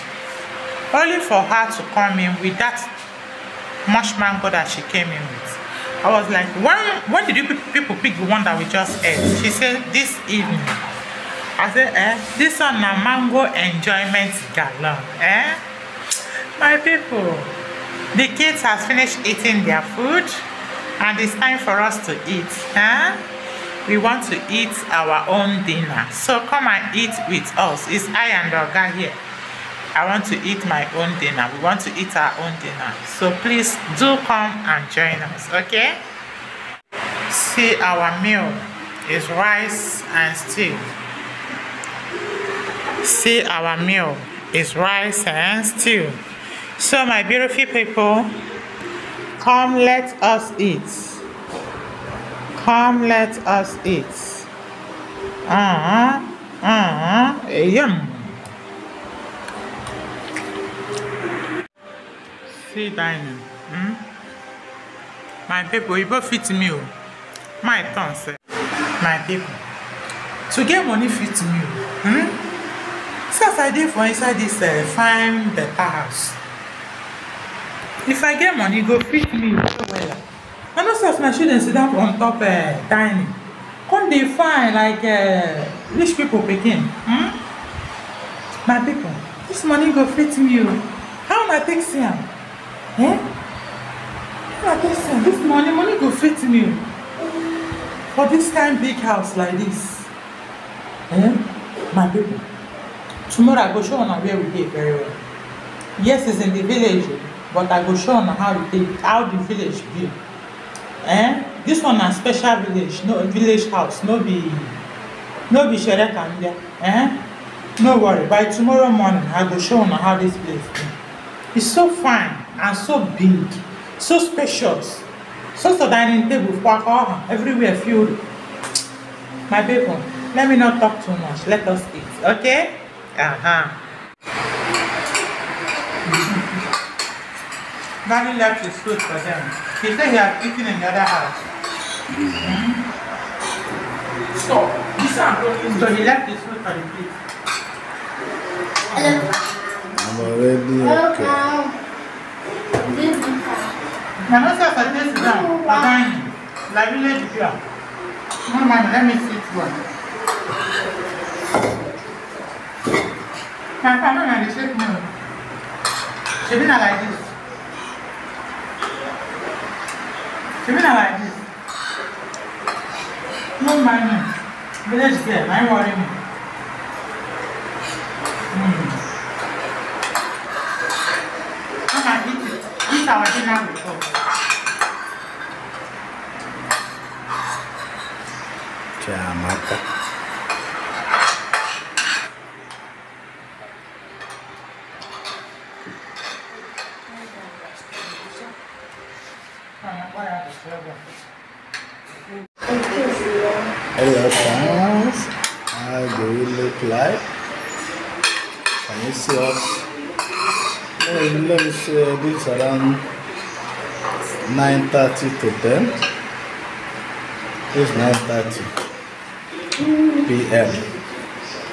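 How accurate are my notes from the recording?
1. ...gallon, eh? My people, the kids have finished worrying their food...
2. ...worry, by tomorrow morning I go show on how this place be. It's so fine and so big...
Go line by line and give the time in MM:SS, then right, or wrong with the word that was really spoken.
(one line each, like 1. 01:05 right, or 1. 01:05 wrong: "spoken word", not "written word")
1. 00:14 wrong: "eating", not "worrying"
2. 01:57 right.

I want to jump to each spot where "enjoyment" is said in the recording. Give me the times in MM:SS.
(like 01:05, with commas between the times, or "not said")
00:13.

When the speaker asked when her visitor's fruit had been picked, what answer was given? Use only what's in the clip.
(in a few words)
This evening.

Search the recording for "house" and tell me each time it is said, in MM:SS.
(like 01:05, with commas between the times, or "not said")
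01:15, 01:38, 01:53, 02:20.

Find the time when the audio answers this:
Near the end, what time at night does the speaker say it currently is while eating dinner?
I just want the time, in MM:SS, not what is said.
03:37.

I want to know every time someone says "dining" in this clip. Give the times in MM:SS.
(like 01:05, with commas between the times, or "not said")
01:02, 01:22, 02:05.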